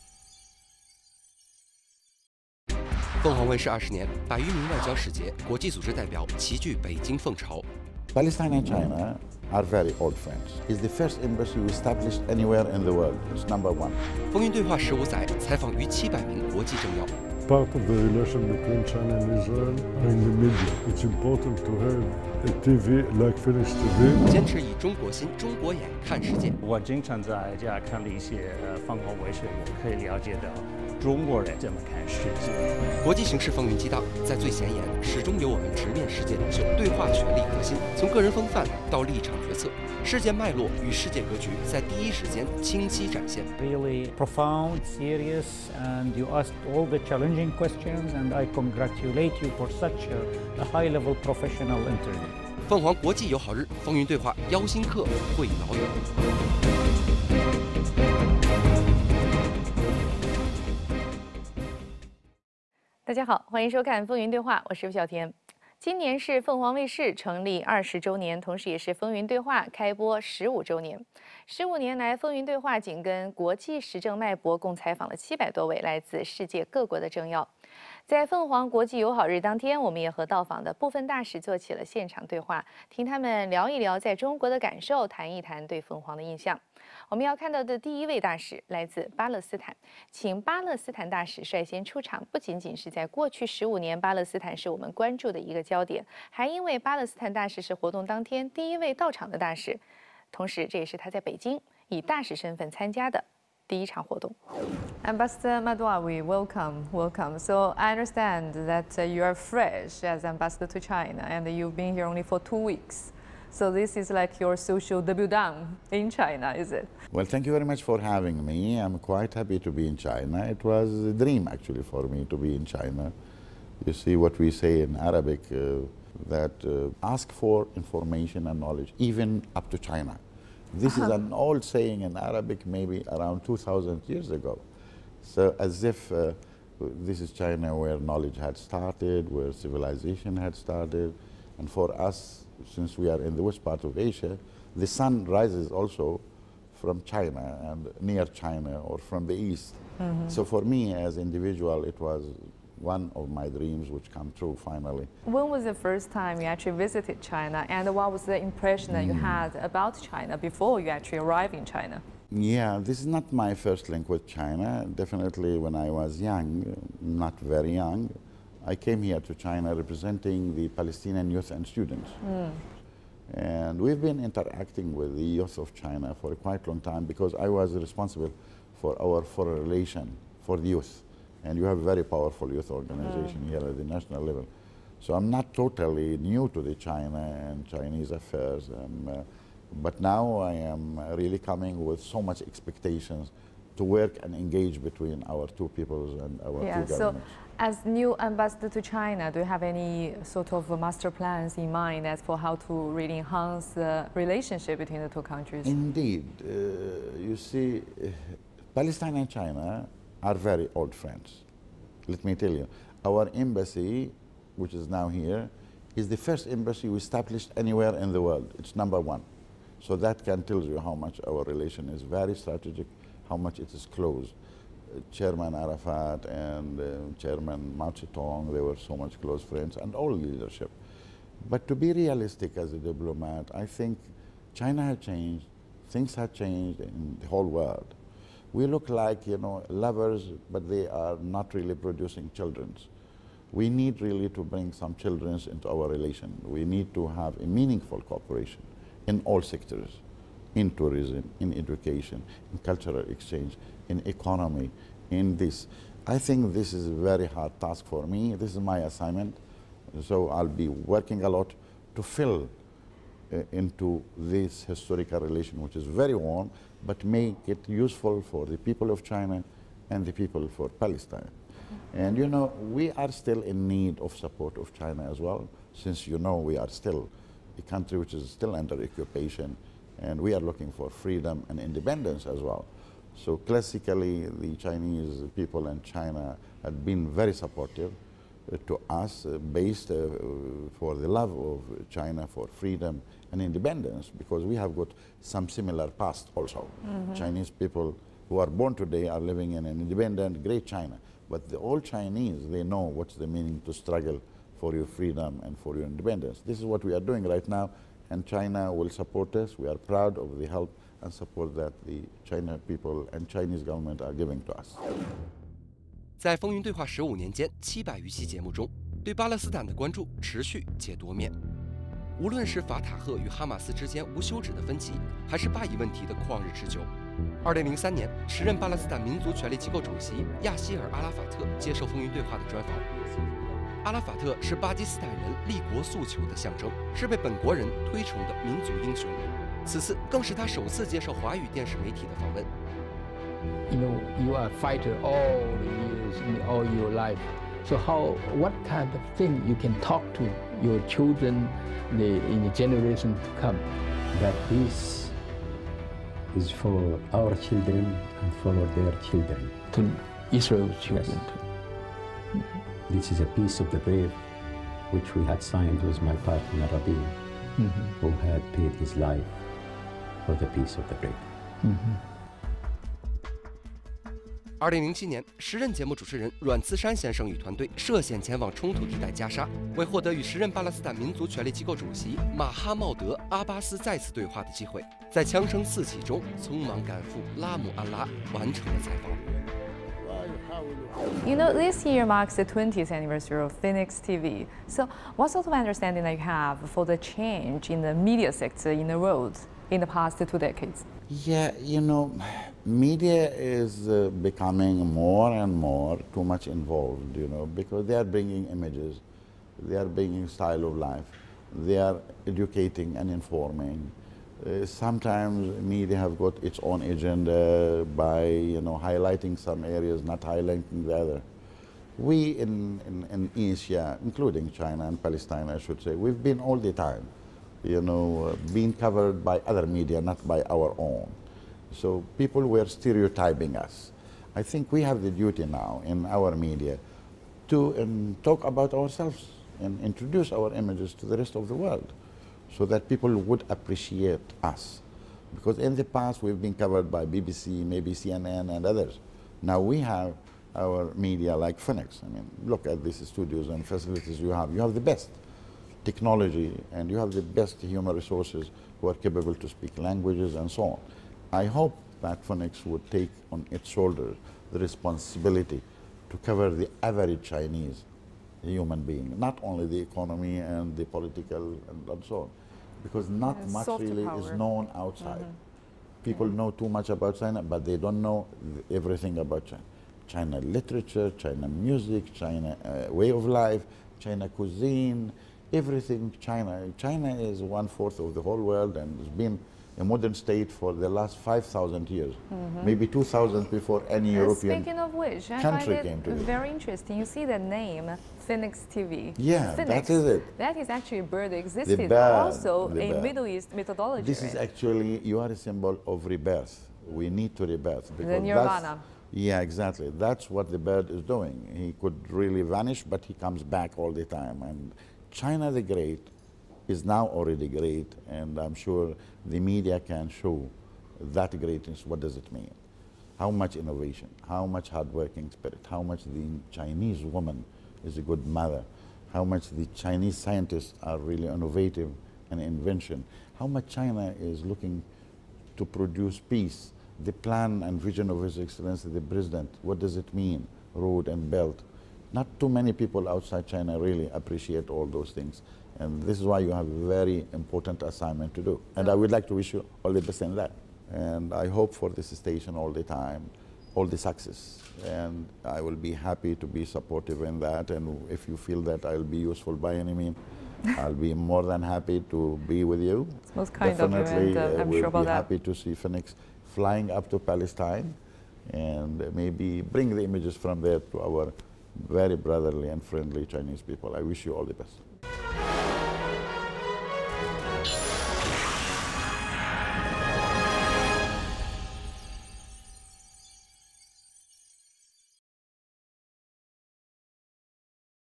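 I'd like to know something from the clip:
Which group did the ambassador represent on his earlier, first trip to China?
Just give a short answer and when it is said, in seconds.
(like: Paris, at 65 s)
Palestinian youth and students, at 170 s.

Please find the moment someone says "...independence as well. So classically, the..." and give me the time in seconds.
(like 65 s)
281 s.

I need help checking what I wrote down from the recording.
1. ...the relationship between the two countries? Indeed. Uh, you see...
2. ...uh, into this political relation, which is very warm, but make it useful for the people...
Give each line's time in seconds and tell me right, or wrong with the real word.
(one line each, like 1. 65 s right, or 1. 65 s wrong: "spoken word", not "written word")
1. 203 s right
2. 263 s wrong: "historical", not "political".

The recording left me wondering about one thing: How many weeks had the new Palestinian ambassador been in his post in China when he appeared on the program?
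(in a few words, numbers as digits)
2 weeks.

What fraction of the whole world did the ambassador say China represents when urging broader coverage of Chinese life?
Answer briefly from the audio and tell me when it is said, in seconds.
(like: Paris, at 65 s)
One-fourth, at 487 s.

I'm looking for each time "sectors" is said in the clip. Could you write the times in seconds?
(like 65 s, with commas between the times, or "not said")
249 s, 398 s.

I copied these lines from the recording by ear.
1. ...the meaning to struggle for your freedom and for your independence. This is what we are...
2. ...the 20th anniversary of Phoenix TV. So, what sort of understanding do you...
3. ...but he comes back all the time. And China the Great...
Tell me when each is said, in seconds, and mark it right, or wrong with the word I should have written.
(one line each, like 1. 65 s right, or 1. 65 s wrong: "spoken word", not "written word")
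1. 303 s right
2. 392 s right
3. 512 s right.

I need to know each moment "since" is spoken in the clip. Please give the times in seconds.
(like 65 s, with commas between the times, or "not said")
142 s, 275 s.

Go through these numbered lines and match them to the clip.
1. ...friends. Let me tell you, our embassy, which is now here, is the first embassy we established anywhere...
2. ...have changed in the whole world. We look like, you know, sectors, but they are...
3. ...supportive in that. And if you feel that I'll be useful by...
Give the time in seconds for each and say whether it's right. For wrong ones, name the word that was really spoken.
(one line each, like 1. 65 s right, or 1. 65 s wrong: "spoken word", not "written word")
1. 210 s right
2. 236 s wrong: "lovers", not "sectors"
3. 556 s right.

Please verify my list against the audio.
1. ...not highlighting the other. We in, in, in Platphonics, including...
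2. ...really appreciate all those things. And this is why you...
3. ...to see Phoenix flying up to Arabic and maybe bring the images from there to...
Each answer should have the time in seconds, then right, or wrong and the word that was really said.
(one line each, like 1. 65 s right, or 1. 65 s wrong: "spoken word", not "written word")
1. 420 s wrong: "Asia", not "Platphonics"
2. 543 s right
3. 565 s wrong: "Palestine", not "Arabic".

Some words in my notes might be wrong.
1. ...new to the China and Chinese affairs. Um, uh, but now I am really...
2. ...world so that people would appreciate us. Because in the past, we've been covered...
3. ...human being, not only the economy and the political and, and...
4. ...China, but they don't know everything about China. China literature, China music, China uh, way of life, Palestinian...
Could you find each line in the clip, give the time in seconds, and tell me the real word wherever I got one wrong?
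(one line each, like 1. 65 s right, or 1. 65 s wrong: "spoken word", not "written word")
1. 186 s right
2. 441 s right
3. 468 s right
4. 477 s wrong: "China", not "Palestinian".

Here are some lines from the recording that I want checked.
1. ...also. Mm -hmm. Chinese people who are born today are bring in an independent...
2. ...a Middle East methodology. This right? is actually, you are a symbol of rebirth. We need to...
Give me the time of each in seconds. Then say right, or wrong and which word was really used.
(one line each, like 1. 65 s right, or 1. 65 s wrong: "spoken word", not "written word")
1. 296 s wrong: "living", not "bring"
2. 502 s right.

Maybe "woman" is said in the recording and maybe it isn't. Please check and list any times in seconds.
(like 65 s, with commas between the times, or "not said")
527 s.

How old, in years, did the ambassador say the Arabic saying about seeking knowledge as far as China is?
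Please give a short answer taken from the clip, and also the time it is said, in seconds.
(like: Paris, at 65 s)
2,000 years, at 133 s.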